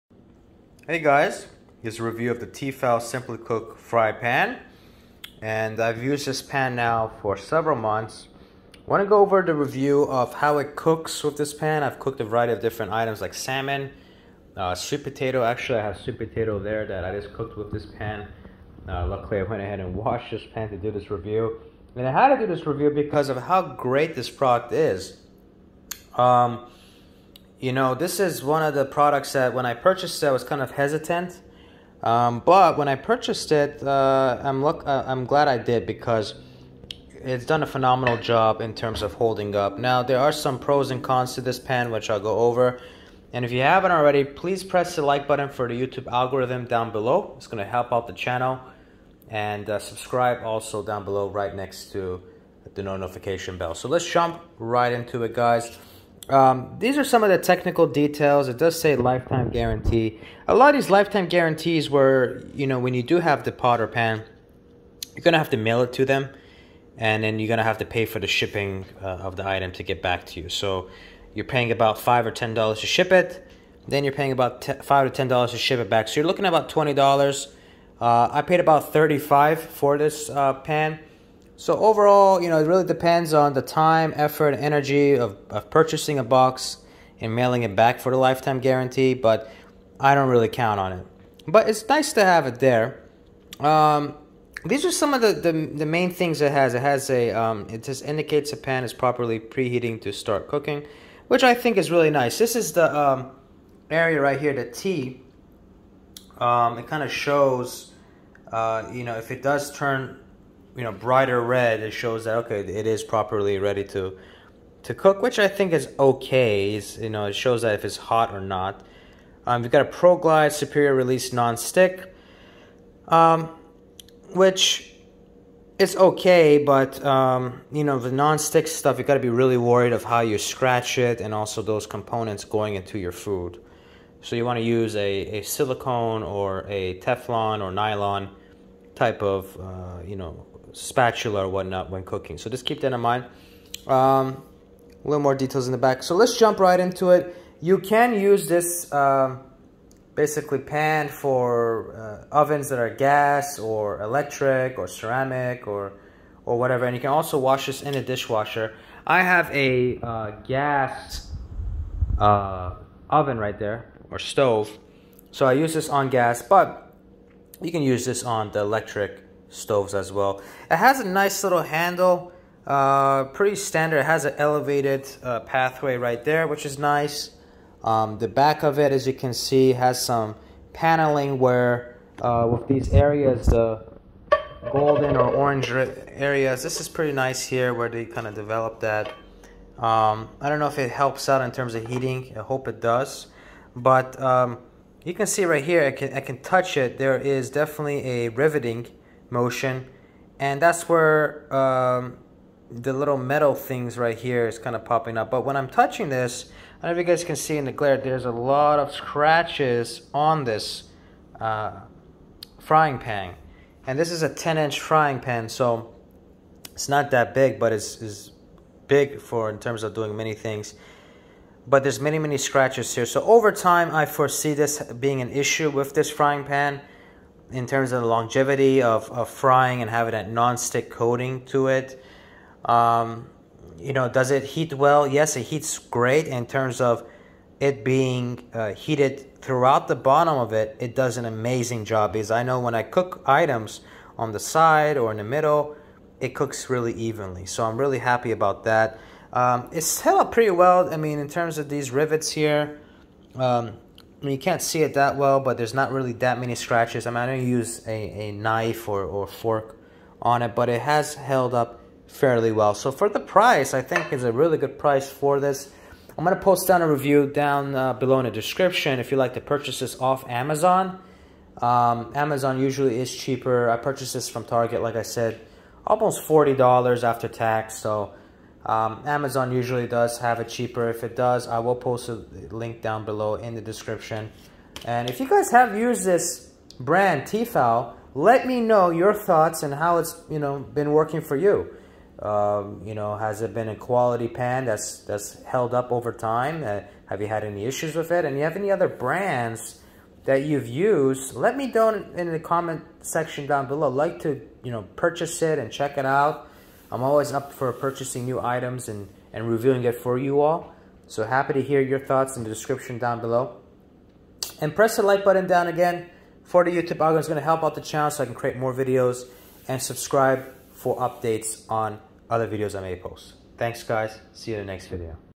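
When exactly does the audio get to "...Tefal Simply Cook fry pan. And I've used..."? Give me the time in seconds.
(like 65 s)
2 s.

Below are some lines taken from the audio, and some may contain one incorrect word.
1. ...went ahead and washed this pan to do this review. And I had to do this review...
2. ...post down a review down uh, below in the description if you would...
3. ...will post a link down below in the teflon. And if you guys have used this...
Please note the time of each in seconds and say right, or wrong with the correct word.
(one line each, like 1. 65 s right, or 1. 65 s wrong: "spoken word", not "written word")
1. 19 s right
2. 266 s right
3. 281 s wrong: "description", not "teflon".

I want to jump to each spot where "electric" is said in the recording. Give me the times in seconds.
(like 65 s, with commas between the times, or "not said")
154 s, 168 s.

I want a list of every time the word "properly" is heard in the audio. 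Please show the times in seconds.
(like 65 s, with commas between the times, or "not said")
98 s, 113 s.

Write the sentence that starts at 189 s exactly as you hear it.
Um, I don't know if it helps out in terms of heating.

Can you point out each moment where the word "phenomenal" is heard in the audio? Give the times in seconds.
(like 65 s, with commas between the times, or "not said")
37 s.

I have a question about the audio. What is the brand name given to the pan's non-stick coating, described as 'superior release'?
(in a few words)
Pro Glide.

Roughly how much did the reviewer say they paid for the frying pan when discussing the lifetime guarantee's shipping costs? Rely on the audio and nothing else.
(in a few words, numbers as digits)
$35.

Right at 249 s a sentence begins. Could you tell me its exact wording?
Um, it's held up pretty well.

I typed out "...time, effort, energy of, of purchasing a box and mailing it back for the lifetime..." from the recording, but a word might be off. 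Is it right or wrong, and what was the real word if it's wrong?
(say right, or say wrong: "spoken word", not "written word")
right.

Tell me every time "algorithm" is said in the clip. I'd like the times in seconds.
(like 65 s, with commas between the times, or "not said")
46 s, 316 s.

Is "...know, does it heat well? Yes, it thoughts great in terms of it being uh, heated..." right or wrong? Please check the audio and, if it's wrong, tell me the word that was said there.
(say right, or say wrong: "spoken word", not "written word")
wrong: "heats", not "thoughts".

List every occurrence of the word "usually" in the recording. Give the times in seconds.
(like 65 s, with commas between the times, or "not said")
272 s, 279 s.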